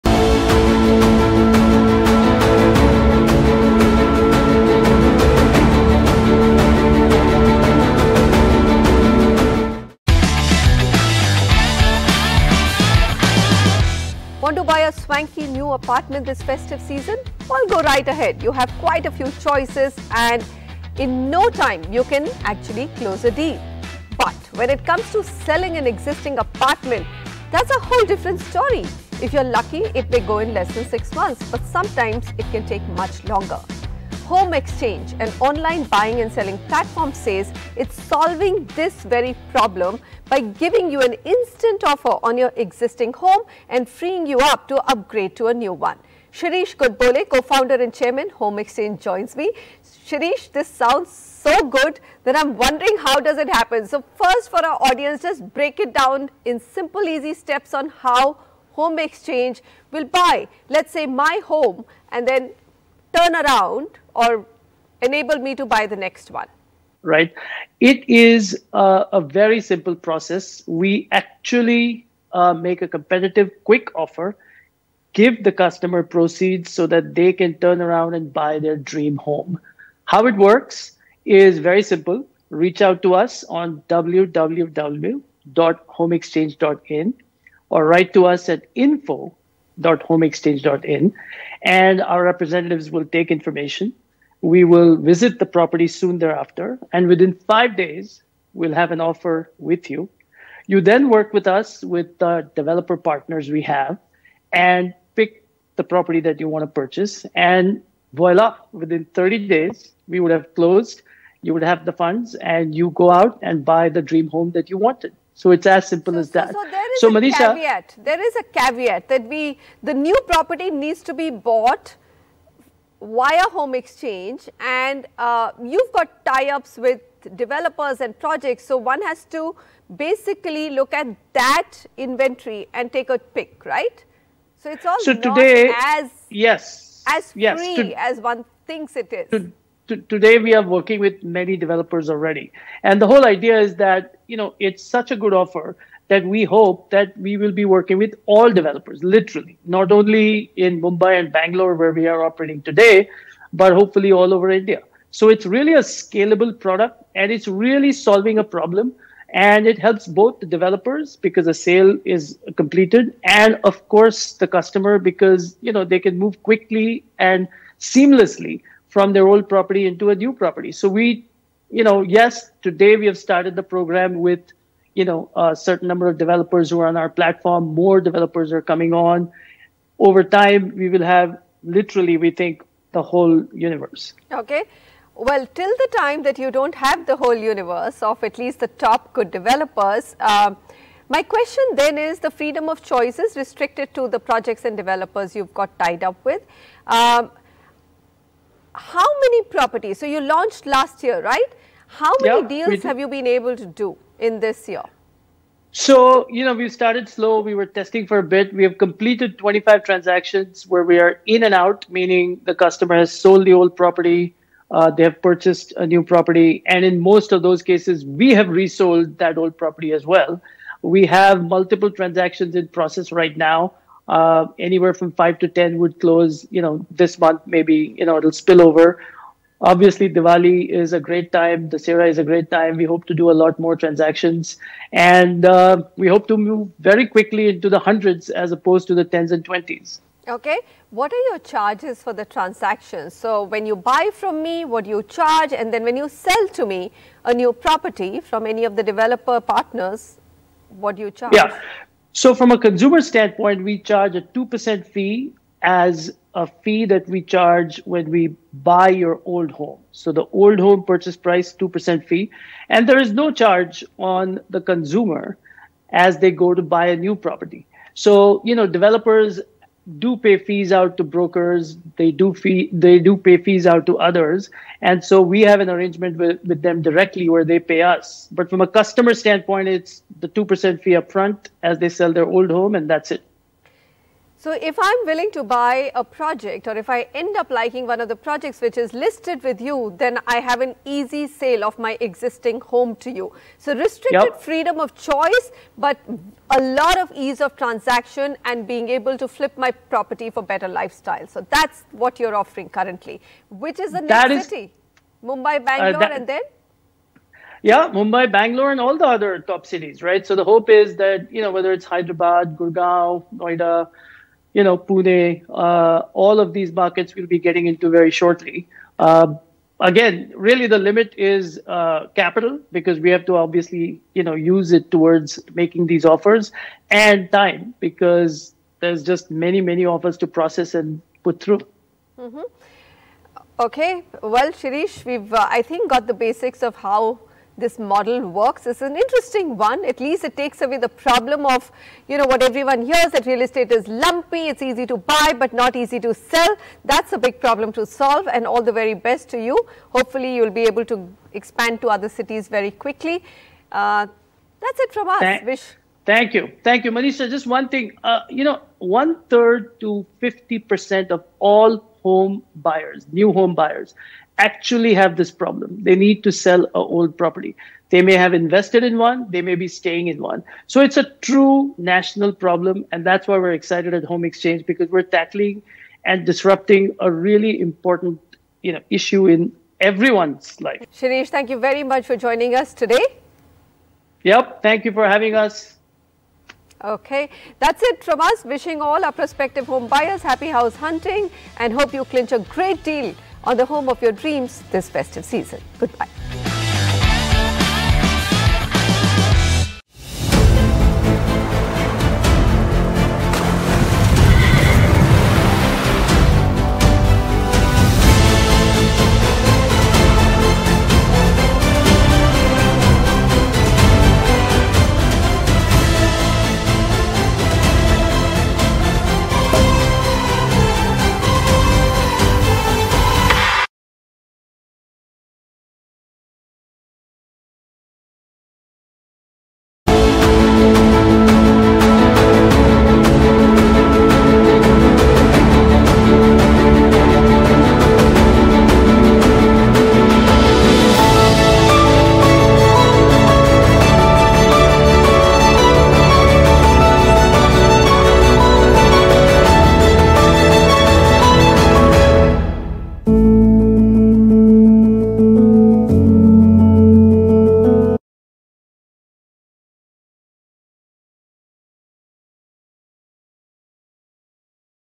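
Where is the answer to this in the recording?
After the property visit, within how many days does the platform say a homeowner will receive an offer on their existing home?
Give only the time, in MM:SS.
01:37.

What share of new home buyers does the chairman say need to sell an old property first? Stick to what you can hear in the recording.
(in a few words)
One third to 50%.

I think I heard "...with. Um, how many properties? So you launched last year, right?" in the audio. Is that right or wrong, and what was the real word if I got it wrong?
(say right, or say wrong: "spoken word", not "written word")
right.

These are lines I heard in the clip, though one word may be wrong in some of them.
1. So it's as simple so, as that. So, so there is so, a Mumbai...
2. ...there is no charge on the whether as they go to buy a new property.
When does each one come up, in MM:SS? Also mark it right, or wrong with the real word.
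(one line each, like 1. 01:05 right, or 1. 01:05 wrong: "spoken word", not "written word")
1. 01:55 wrong: "Manisha", not "Mumbai"
2. 04:22 wrong: "consumer", not "whether".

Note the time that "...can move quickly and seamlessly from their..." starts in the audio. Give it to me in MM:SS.
02:45.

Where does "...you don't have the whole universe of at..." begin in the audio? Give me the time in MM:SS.
03:06.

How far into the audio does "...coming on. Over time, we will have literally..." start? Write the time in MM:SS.
02:58.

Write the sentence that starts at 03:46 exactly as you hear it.
You know, this month maybe you know it'll spill over.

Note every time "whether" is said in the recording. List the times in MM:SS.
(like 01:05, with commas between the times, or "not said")
05:11.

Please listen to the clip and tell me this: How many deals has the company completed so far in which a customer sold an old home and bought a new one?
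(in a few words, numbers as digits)
25.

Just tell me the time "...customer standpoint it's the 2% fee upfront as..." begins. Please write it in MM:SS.
04:38.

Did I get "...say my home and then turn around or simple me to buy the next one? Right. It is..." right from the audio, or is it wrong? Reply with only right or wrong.
wrong.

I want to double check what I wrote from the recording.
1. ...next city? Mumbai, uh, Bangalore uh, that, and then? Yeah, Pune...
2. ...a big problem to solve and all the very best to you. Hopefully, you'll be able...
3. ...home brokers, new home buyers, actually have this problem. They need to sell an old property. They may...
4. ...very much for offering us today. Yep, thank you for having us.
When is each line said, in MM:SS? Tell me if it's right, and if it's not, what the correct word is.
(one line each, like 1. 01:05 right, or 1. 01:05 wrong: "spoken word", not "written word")
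1. 05:04 wrong: "Mumbai", not "Pune"
2. 05:47 right
3. 06:02 wrong: "buyers", not "brokers"
4. 06:21 wrong: "joining", not "offering".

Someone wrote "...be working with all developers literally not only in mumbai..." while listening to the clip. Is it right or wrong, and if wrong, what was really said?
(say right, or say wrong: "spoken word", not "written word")
right.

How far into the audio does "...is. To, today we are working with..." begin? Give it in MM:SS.
02:19.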